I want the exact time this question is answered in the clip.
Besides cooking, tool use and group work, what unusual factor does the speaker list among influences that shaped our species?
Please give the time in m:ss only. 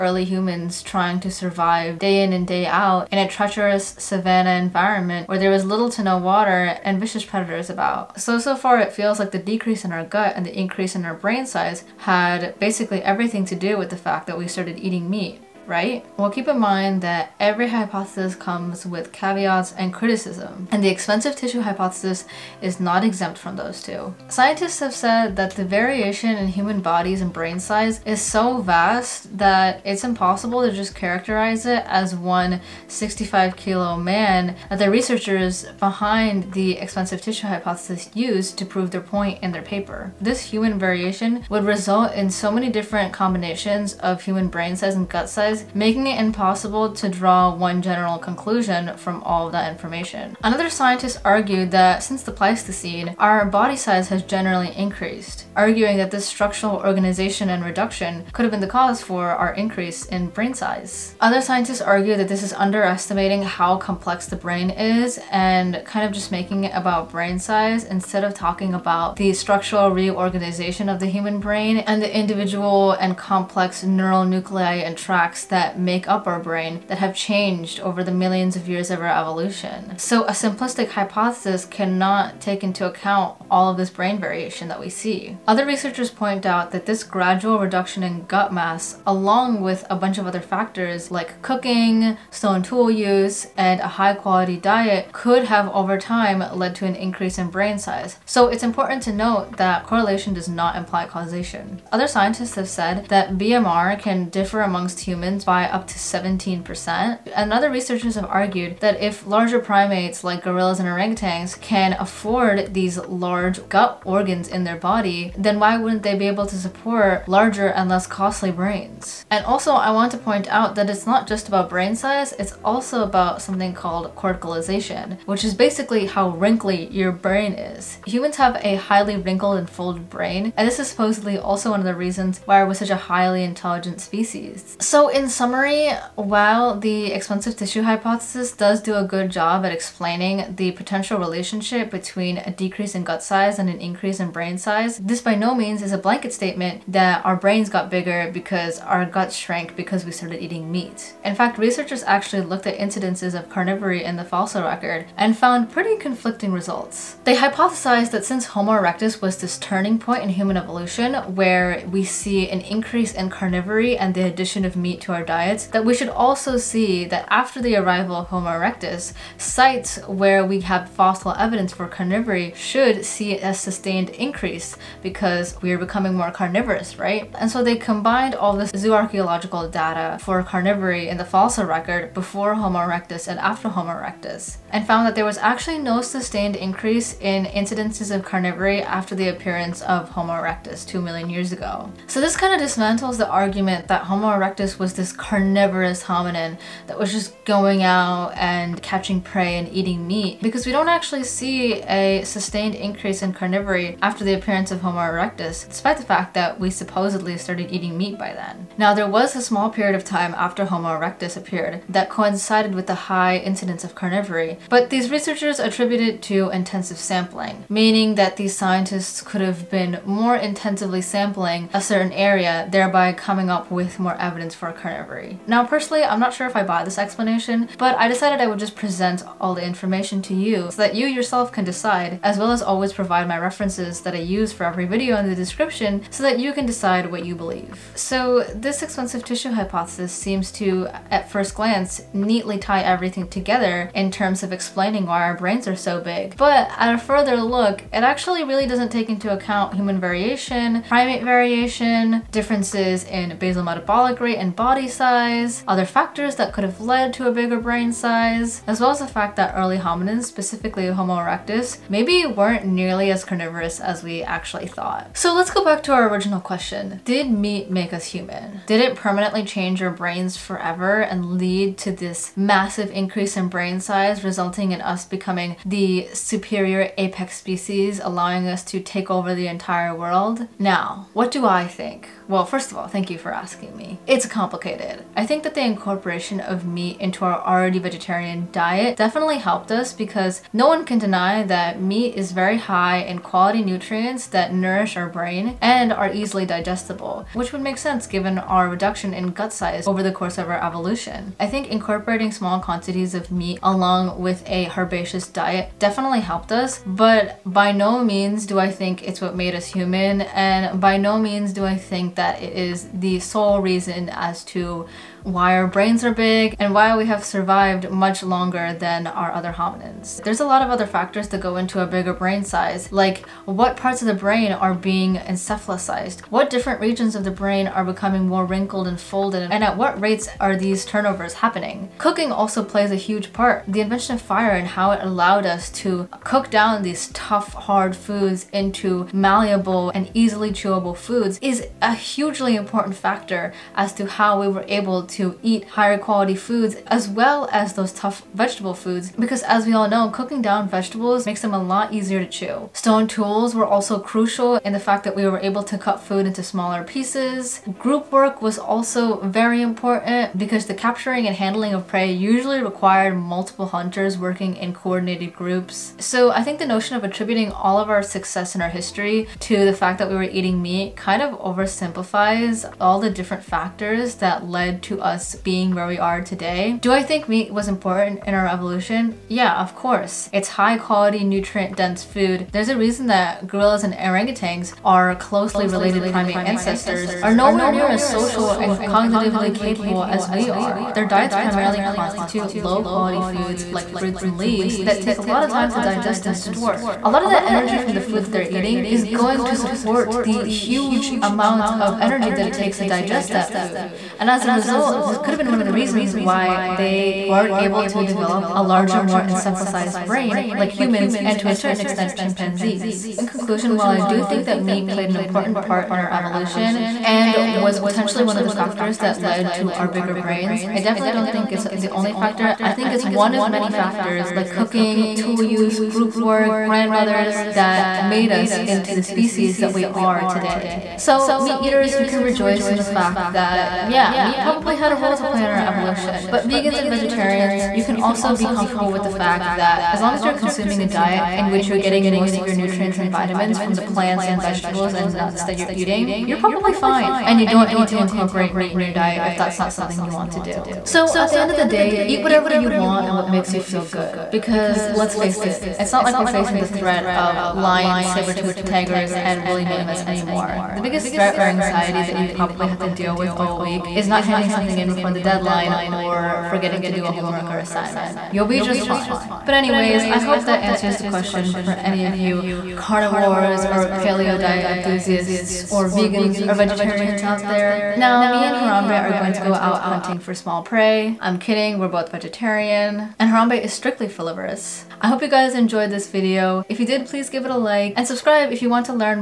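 7:06.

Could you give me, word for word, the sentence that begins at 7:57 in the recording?
Now, me and Harambe are going to go out hunting for small prey.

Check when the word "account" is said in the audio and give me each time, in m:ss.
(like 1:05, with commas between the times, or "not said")
1:22, 4:09.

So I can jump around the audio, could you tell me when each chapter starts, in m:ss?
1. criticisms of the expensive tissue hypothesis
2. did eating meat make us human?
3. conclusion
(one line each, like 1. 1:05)
1. 0:07
2. 4:24
3. 6:52.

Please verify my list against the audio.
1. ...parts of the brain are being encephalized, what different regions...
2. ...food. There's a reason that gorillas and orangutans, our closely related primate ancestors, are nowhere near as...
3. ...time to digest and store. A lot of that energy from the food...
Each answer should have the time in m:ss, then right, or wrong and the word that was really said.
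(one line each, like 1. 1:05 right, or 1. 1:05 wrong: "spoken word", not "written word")
1. 5:23 right
2. 6:22 right
3. 6:35 right.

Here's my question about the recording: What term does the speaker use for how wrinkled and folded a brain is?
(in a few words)
corticalization.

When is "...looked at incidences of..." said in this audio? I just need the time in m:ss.
2:32.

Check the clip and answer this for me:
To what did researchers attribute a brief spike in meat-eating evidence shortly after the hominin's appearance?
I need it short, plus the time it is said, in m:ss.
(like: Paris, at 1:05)
intensive sampling, at 3:36.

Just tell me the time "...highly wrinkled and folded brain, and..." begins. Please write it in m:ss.
2:08.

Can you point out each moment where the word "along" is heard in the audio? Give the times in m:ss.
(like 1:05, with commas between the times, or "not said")
1:29, 5:03.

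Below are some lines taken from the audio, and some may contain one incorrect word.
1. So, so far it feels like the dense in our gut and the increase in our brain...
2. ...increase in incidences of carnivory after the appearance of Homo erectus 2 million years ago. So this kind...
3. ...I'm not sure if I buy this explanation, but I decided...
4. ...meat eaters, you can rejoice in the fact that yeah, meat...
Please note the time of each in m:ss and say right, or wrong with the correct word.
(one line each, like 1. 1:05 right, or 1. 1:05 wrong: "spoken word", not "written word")
1. 0:08 wrong: "decrease", not "dense"
2. 3:06 right
3. 3:46 right
4. 7:11 right.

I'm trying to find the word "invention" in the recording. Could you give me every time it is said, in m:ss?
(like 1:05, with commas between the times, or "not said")
5:33.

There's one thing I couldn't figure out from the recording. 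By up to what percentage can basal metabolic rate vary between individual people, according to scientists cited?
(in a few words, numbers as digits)
17%.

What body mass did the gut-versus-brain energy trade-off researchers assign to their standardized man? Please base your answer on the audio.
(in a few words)
65 kilos.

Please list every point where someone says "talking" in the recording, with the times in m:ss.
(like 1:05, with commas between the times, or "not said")
1:08.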